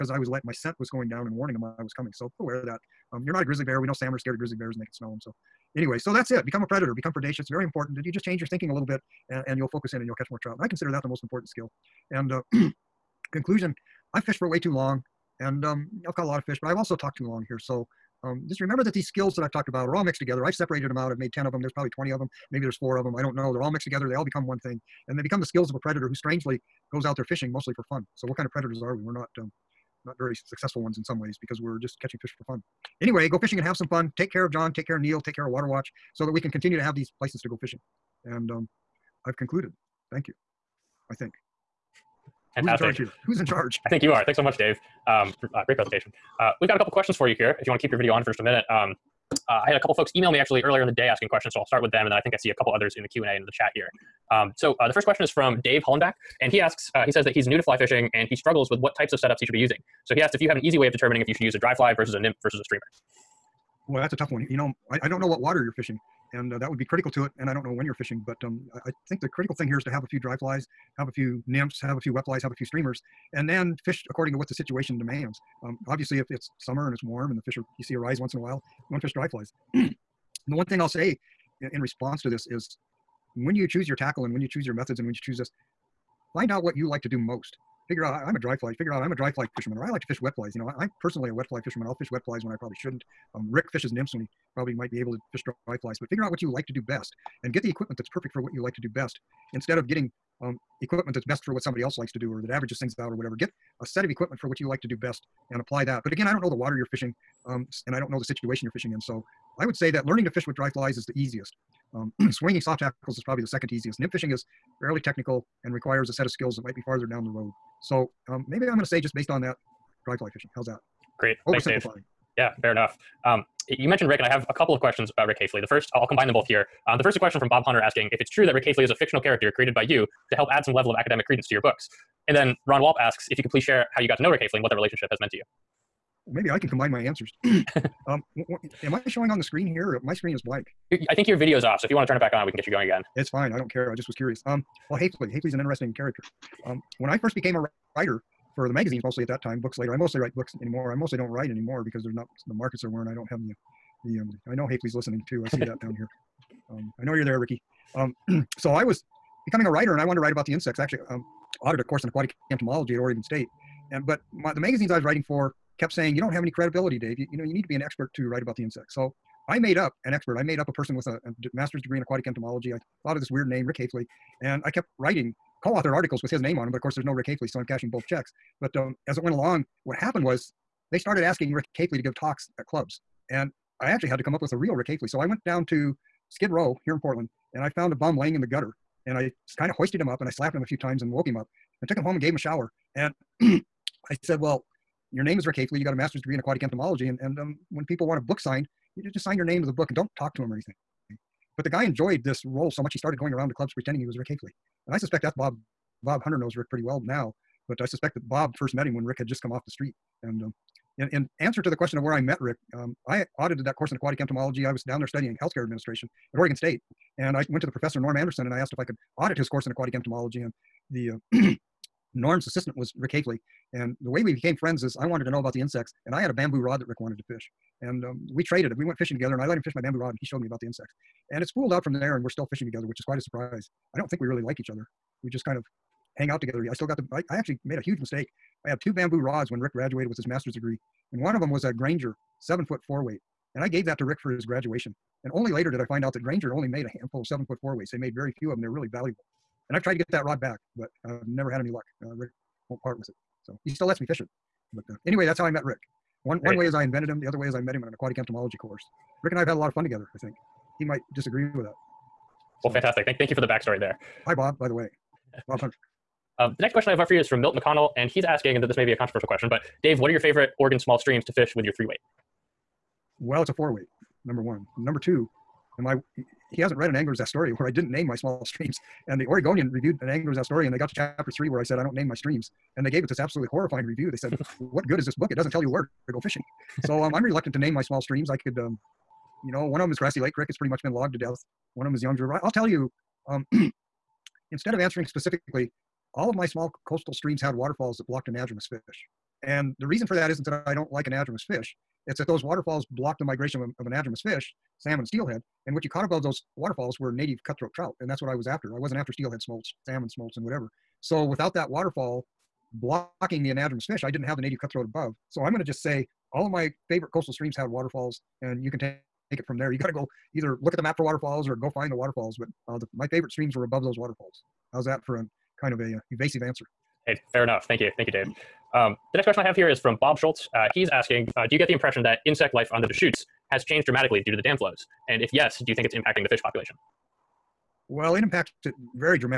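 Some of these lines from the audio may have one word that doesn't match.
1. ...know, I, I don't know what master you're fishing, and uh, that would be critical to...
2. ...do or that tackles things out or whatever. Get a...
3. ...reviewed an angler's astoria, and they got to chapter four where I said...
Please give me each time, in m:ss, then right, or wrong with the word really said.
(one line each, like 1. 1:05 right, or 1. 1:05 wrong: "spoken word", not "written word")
1. 1:04 wrong: "water", not "master"
2. 1:42 wrong: "averages", not "tackles"
3. 4:39 wrong: "three", not "four".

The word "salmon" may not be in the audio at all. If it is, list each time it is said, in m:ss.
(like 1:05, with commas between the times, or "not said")
0:03, 5:04, 5:09.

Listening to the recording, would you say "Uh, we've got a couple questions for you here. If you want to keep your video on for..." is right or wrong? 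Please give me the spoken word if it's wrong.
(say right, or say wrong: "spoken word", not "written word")
right.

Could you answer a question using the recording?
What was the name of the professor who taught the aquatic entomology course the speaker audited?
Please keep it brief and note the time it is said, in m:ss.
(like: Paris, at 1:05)
Norm Anderson, at 3:37.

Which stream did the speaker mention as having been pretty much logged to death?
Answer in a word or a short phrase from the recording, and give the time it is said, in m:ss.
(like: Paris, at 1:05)
Grassy Lake Creek, at 4:49.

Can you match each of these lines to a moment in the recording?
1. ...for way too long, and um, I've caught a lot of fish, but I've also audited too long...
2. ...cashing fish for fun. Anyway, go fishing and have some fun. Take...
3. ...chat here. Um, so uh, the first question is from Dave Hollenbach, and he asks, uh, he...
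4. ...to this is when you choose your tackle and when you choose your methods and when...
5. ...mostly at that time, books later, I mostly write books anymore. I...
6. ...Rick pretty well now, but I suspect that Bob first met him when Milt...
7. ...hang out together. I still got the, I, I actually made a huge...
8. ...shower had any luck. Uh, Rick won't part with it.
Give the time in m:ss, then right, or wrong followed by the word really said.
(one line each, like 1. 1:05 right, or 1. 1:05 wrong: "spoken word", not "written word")
1. 0:14 wrong: "talked", not "audited"
2. 0:32 wrong: "catching", not "cashing"
3. 0:53 right
4. 1:22 right
5. 2:29 right
6. 3:26 wrong: "Rick", not "Milt"
7. 3:56 right
8. 4:11 wrong: "never", not "shower".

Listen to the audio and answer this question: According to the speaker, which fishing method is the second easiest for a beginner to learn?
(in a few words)
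swinging soft tackles.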